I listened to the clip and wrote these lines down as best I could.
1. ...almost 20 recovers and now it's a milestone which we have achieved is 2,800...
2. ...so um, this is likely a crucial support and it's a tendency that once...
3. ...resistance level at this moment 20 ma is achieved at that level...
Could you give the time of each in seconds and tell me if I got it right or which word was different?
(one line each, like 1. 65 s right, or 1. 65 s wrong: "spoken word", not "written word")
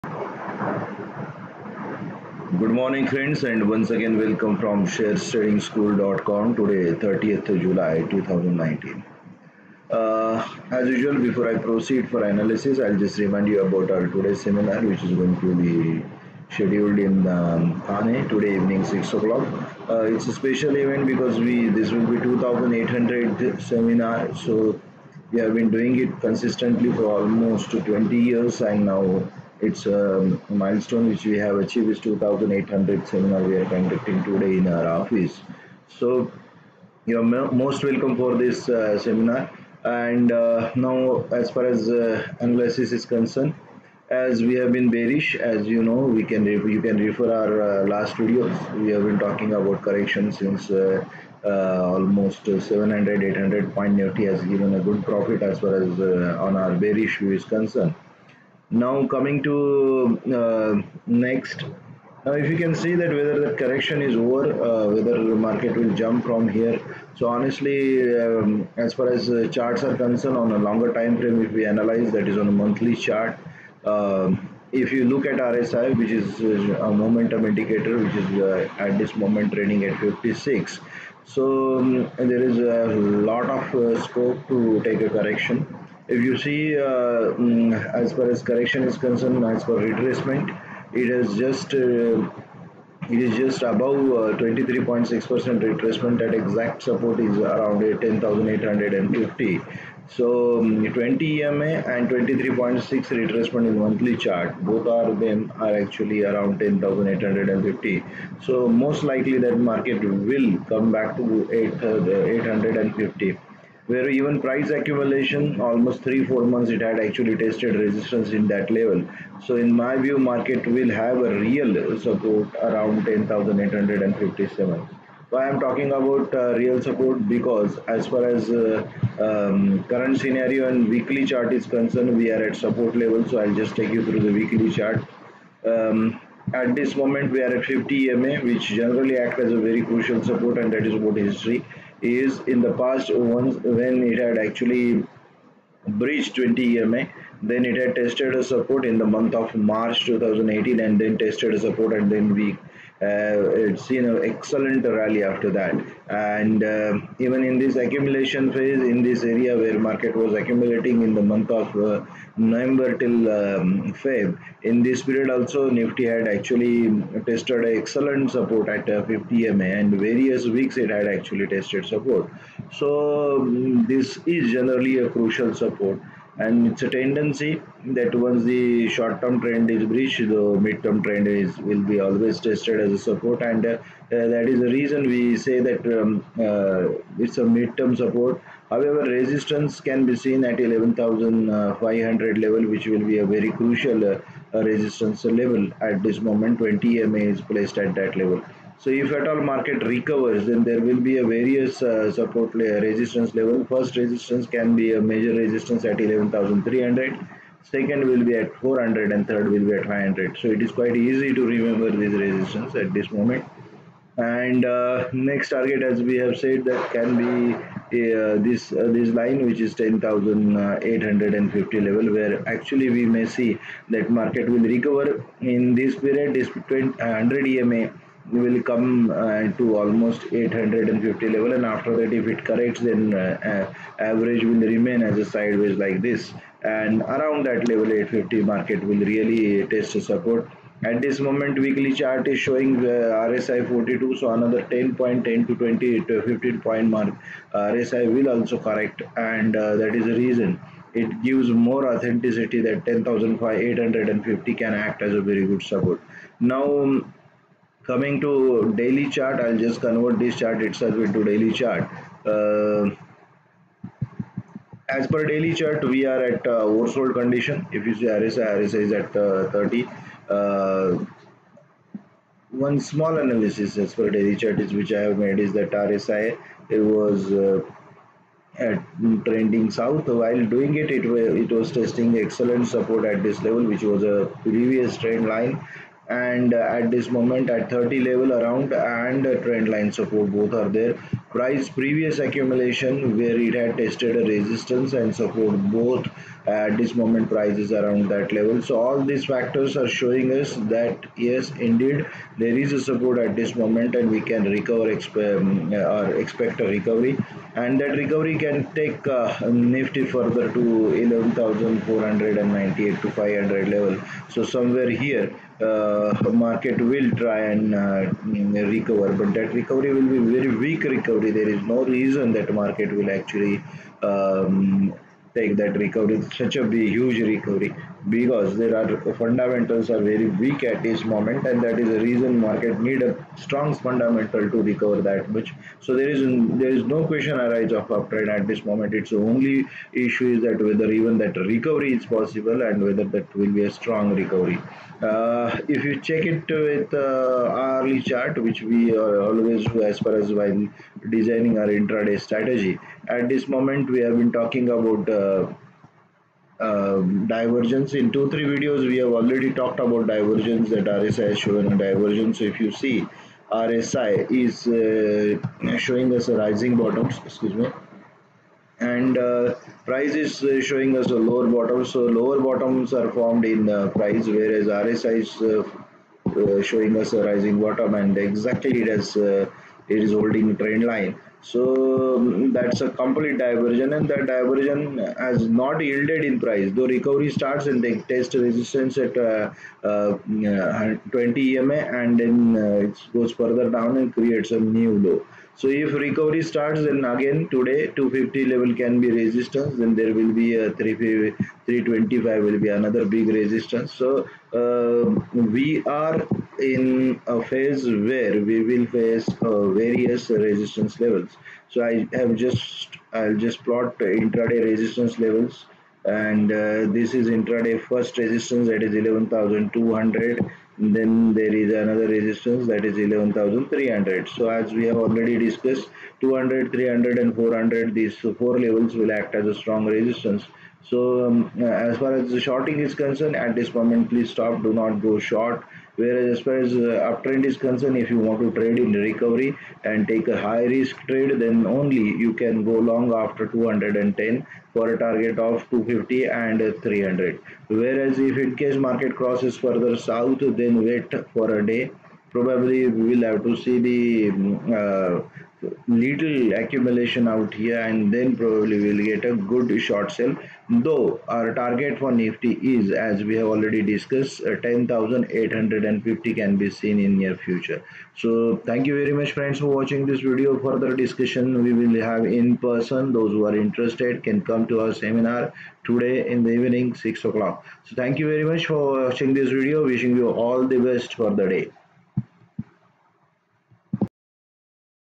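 1. 27 s wrong: "years", not "recovers"
2. 172 s wrong: "generally", not "likely"
3. 194 s wrong: "placed", not "achieved".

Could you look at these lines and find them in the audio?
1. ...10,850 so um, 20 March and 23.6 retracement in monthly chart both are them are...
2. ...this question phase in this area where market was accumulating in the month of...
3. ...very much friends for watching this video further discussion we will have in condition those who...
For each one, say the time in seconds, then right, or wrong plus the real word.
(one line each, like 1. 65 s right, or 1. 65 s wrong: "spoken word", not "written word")
1. 97 s wrong: "EMA", not "March"
2. 157 s wrong: "accumulation", not "question"
3. 468 s wrong: "person", not "condition".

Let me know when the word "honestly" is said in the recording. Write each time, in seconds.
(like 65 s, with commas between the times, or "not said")
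67 s.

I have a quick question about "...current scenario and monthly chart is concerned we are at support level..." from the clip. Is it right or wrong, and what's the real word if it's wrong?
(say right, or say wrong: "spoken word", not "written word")
wrong: "weekly", not "monthly".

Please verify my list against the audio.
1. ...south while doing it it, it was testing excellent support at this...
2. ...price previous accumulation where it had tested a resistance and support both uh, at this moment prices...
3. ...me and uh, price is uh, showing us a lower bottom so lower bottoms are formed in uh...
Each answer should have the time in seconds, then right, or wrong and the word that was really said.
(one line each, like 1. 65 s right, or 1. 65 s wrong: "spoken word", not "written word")
1. 279 s right
2. 291 s right
3. 367 s right.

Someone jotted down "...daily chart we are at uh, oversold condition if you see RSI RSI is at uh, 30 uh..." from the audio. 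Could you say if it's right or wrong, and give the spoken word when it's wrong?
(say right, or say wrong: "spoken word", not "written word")
right.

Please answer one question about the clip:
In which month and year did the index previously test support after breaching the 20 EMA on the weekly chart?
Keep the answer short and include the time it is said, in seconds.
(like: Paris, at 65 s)
March 2018, at 149 s.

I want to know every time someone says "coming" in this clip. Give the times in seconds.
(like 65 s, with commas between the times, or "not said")
59 s, 257 s.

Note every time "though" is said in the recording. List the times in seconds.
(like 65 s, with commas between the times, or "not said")
386 s, 460 s.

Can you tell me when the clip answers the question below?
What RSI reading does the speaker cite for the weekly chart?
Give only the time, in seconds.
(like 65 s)
243 s.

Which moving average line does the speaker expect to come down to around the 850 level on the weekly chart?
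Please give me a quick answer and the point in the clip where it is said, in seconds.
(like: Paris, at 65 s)
100 EMA, at 226 s.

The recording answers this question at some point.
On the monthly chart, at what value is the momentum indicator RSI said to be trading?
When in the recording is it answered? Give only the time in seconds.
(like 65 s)
79 s.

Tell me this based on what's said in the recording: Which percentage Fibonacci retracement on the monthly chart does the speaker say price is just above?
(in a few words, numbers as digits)
23.6 percent.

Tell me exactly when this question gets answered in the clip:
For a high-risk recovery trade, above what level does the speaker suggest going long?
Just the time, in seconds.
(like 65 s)
443 s.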